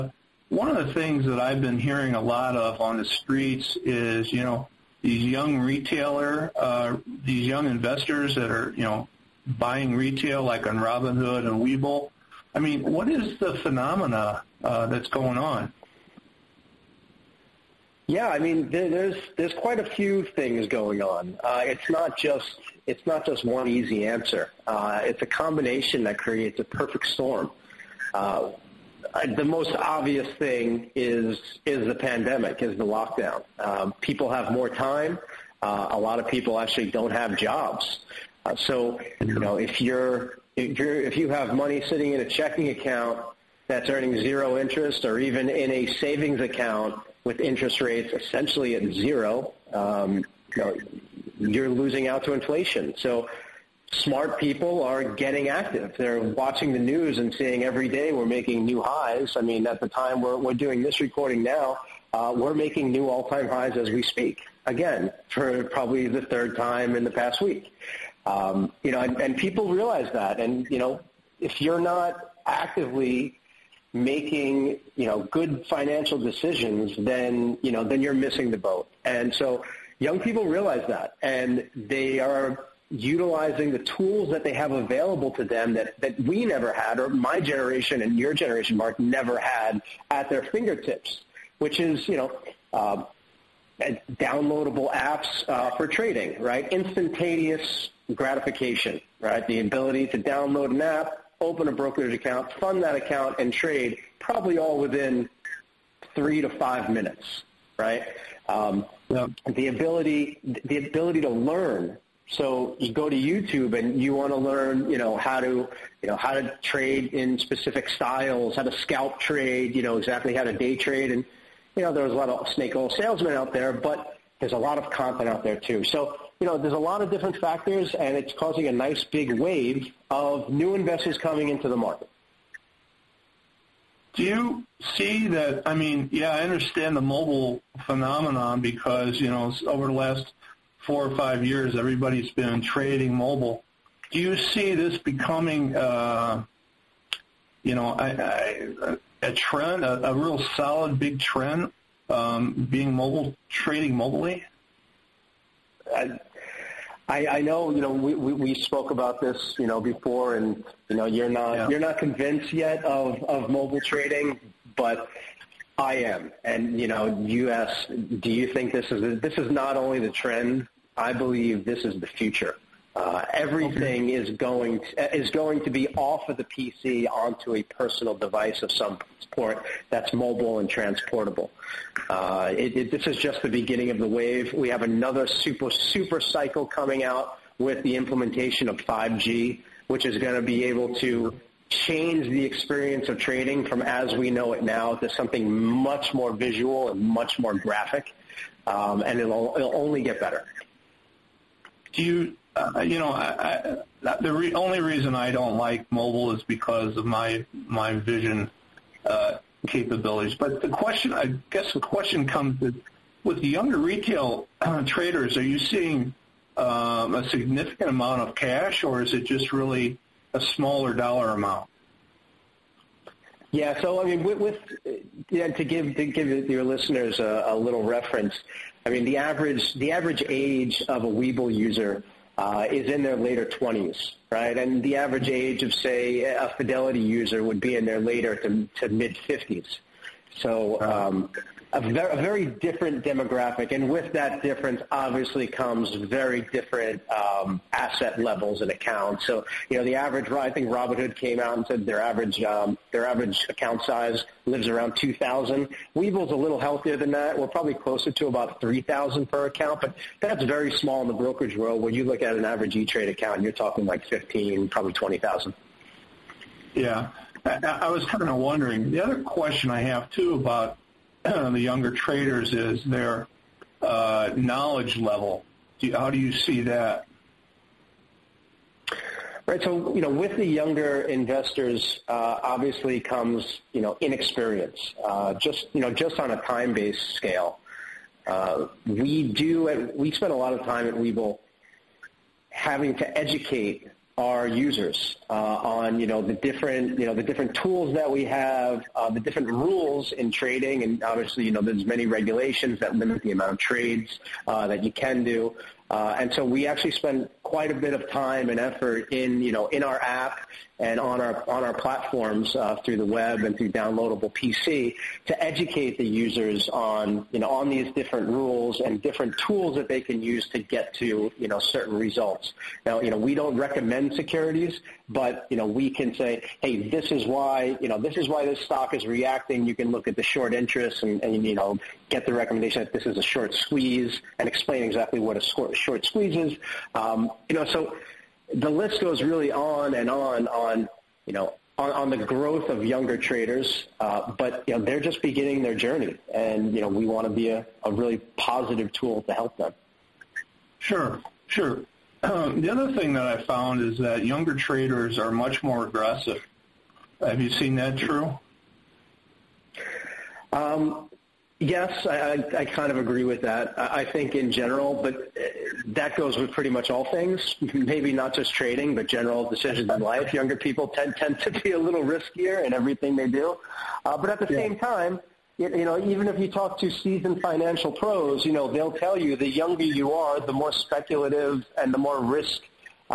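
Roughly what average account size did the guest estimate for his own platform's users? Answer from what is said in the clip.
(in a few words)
3,000.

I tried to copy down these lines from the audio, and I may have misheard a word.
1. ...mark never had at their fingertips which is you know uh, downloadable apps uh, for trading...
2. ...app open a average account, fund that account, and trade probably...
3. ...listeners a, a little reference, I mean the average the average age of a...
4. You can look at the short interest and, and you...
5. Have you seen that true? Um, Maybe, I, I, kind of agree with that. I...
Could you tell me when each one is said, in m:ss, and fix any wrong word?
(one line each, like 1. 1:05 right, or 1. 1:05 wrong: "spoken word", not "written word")
1. 1:28 right
2. 1:40 wrong: "brokerage", not "average"
3. 3:46 right
4. 5:29 right
5. 5:57 wrong: "Yes", not "Maybe".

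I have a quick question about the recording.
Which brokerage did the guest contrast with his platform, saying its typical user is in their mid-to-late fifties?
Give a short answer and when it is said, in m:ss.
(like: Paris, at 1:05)
Fidelity, at 3:56.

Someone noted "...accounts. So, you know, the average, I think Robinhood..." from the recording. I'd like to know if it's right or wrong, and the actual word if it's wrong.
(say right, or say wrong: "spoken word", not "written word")
right.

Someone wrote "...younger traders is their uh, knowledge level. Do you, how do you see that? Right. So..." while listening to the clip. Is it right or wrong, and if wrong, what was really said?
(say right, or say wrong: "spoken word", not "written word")
right.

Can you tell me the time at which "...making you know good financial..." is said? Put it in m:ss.
1:13.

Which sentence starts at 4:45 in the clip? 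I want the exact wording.
Uh, just, you know, just on a time-based scale, uh, we do.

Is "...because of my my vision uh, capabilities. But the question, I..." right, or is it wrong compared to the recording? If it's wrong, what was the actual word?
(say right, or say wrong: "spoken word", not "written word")
right.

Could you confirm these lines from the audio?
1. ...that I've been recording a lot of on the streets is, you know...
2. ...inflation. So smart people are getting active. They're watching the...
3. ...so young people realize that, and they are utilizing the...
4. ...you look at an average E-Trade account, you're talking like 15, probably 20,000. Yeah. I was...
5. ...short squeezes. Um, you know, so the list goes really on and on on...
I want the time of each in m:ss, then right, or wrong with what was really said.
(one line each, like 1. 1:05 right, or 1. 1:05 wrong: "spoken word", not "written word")
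1. 0:01 wrong: "hearing", not "recording"
2. 0:52 right
3. 1:19 right
4. 4:21 right
5. 5:35 right.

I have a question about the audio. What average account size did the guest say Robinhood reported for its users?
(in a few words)
2,000.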